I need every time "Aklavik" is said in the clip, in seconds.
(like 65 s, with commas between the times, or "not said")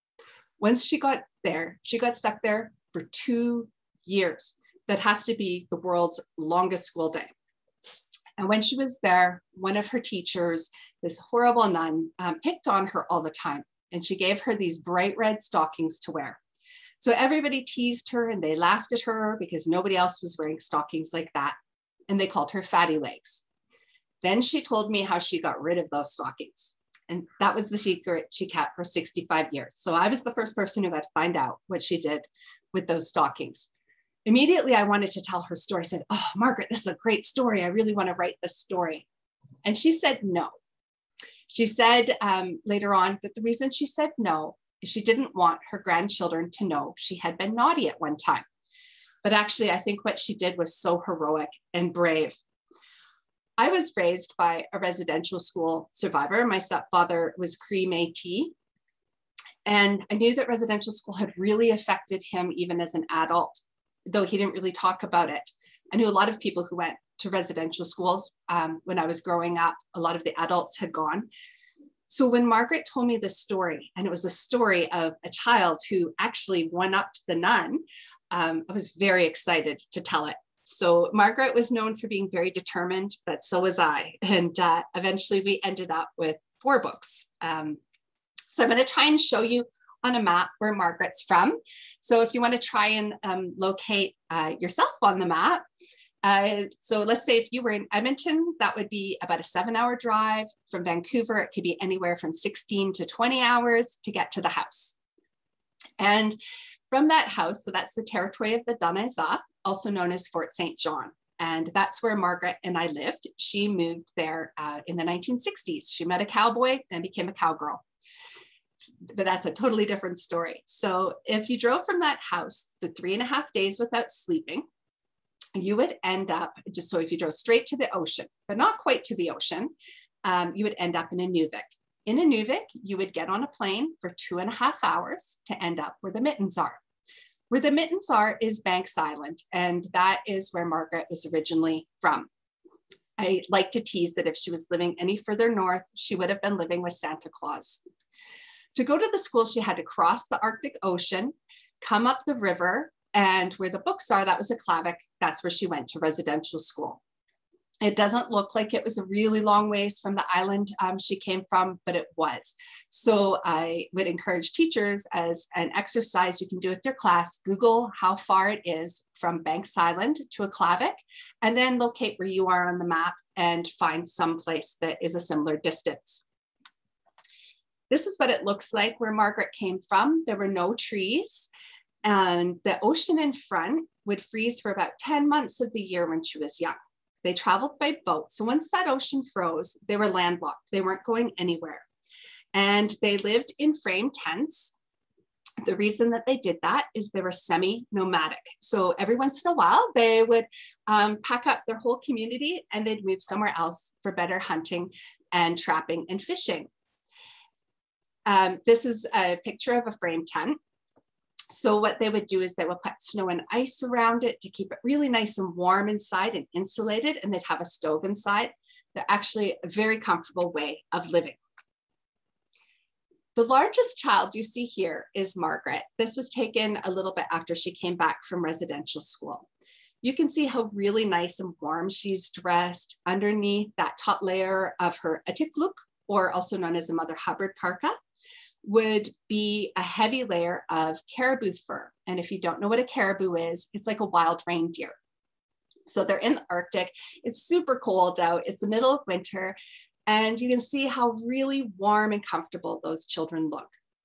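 154 s, 170 s.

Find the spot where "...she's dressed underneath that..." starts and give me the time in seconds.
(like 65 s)
231 s.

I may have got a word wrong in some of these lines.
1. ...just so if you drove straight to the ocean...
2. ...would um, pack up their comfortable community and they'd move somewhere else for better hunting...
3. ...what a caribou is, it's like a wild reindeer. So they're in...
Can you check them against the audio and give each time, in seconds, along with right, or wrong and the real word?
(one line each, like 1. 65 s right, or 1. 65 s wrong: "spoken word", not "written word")
1. 126 s right
2. 200 s wrong: "whole", not "comfortable"
3. 242 s right.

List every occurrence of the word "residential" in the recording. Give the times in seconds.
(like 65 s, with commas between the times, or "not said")
54 s, 60 s, 67 s, 155 s, 228 s.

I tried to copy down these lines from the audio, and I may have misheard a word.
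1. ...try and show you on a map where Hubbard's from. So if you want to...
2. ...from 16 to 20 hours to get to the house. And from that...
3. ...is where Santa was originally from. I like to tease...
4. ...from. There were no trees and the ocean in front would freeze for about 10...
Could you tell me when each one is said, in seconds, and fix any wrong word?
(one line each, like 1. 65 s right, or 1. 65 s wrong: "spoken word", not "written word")
1. 88 s wrong: "Margaret", not "Hubbard"
2. 102 s right
3. 140 s wrong: "Margaret", not "Santa"
4. 179 s right.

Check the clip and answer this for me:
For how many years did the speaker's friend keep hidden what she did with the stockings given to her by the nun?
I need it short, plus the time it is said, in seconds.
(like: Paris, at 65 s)
65 years, at 28 s.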